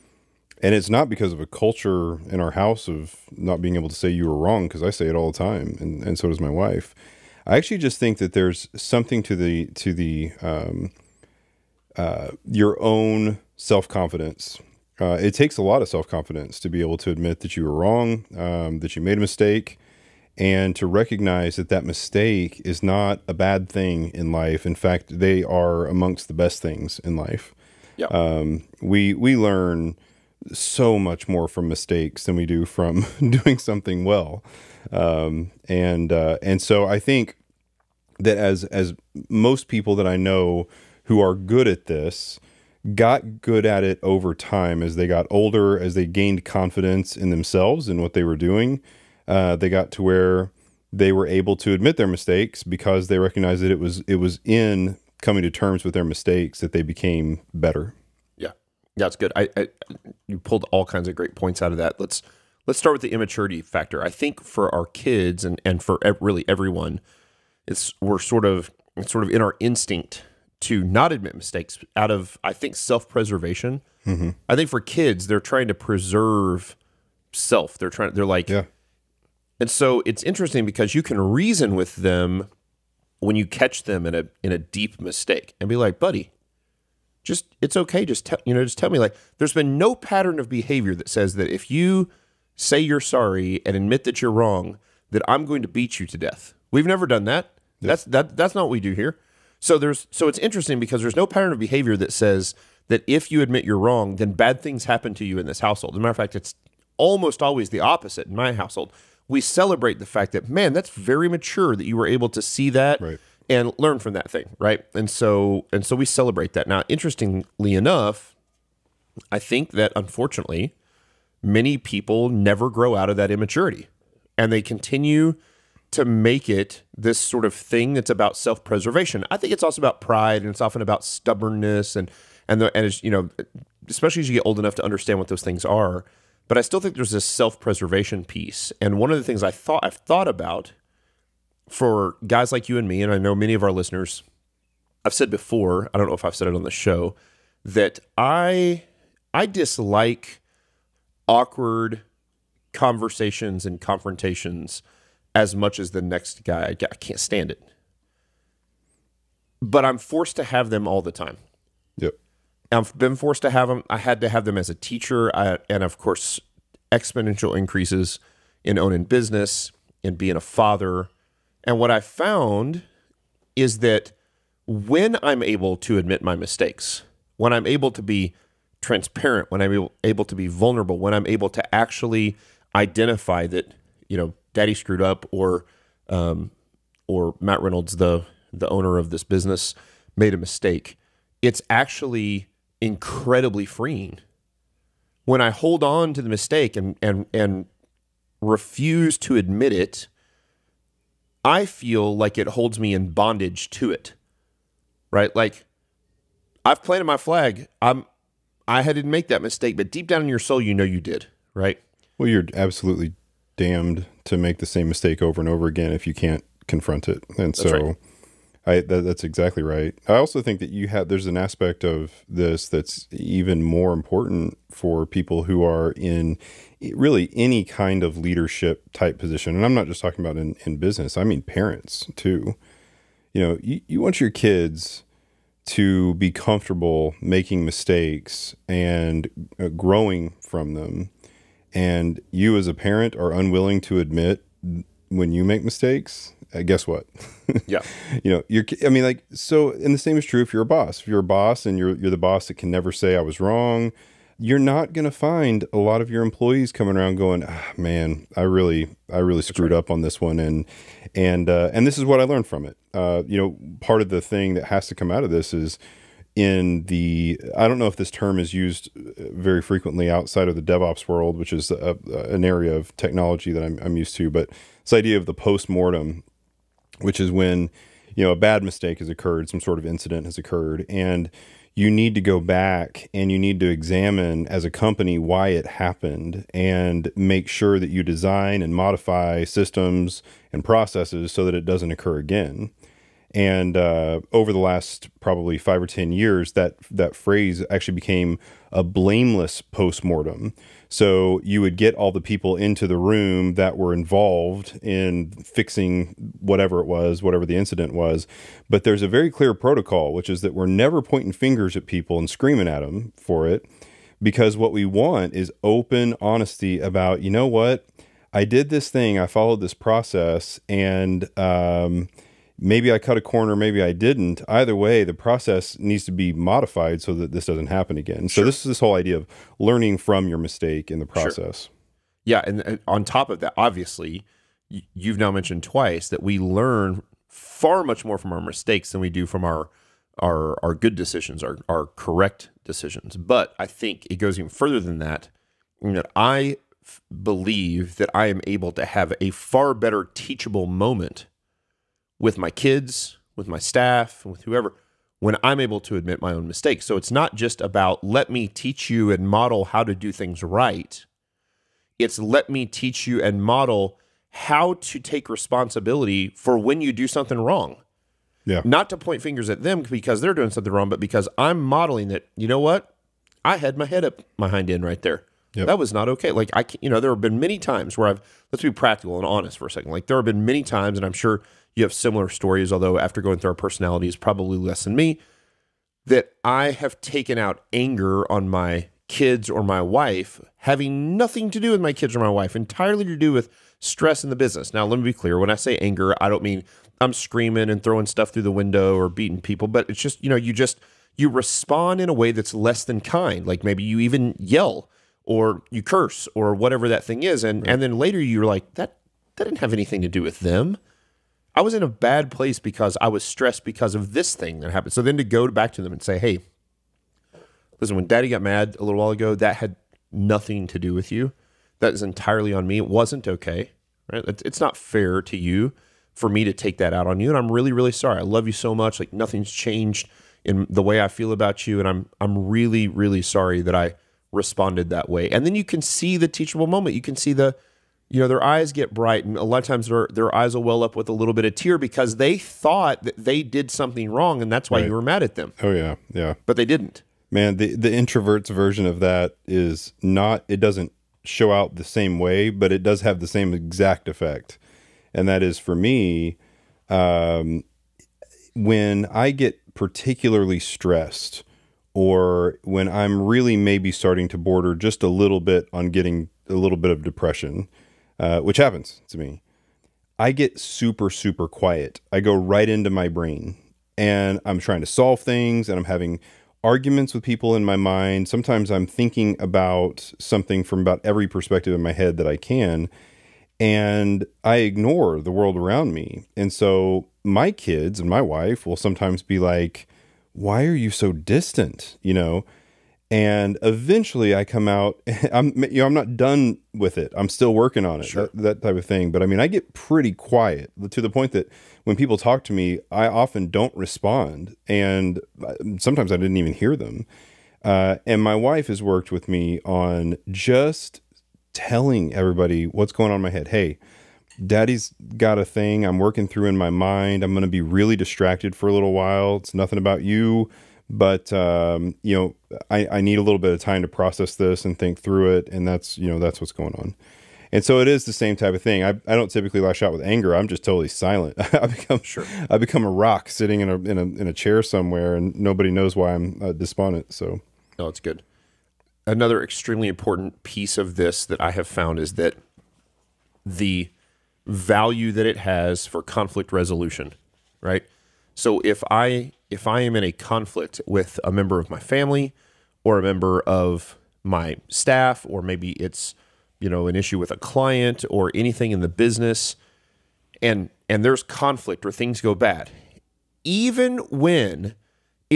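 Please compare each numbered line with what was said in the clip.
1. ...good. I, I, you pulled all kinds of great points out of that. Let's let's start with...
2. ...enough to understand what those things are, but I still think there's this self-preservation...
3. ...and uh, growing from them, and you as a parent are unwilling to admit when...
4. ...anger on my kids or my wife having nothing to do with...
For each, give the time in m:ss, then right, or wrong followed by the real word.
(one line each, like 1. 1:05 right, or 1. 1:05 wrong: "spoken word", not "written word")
1. 0:59 right
2. 2:14 right
3. 3:58 right
4. 6:27 right.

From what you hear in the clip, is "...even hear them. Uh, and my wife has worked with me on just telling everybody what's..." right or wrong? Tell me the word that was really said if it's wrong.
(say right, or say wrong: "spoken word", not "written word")
right.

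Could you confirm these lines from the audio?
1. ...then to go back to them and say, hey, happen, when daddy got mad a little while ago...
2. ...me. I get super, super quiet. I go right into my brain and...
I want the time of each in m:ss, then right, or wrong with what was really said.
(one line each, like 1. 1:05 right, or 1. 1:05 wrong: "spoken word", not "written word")
1. 6:55 wrong: "listen", not "happen"
2. 7:49 right.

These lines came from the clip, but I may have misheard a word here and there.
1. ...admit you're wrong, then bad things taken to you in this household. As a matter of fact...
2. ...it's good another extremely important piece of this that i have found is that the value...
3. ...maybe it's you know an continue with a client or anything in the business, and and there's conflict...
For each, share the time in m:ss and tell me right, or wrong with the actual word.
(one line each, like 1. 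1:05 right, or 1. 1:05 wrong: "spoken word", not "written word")
1. 1:43 wrong: "happen", not "taken"
2. 8:57 right
3. 9:15 wrong: "issue", not "continue".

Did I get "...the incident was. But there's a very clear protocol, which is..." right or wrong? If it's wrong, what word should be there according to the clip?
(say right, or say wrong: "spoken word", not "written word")
right.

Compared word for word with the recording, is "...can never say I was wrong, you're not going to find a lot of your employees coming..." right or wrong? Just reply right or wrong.
right.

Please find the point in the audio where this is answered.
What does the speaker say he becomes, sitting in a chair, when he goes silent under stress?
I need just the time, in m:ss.
8:52.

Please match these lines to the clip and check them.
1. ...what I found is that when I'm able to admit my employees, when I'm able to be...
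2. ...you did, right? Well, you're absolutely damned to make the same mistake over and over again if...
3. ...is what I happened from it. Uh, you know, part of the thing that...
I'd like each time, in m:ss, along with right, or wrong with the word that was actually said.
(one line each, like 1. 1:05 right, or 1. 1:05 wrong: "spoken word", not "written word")
1. 2:51 wrong: "mistakes", not "employees"
2. 3:30 right
3. 4:21 wrong: "learned", not "happened".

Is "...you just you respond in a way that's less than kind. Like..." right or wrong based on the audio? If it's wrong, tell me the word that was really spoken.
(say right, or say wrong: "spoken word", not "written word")
right.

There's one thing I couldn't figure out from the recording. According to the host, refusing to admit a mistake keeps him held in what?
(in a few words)
bondage.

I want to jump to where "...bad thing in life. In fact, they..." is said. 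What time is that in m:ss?
0:23.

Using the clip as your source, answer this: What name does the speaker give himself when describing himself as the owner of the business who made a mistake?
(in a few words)
Matt Reynolds.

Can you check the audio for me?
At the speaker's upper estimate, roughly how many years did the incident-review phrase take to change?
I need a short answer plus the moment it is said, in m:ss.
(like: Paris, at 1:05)
10, at 4:55.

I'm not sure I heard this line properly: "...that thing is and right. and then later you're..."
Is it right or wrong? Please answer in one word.
right.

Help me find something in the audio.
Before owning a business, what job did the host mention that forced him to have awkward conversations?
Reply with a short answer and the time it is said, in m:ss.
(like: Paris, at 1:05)
teacher, at 2:44.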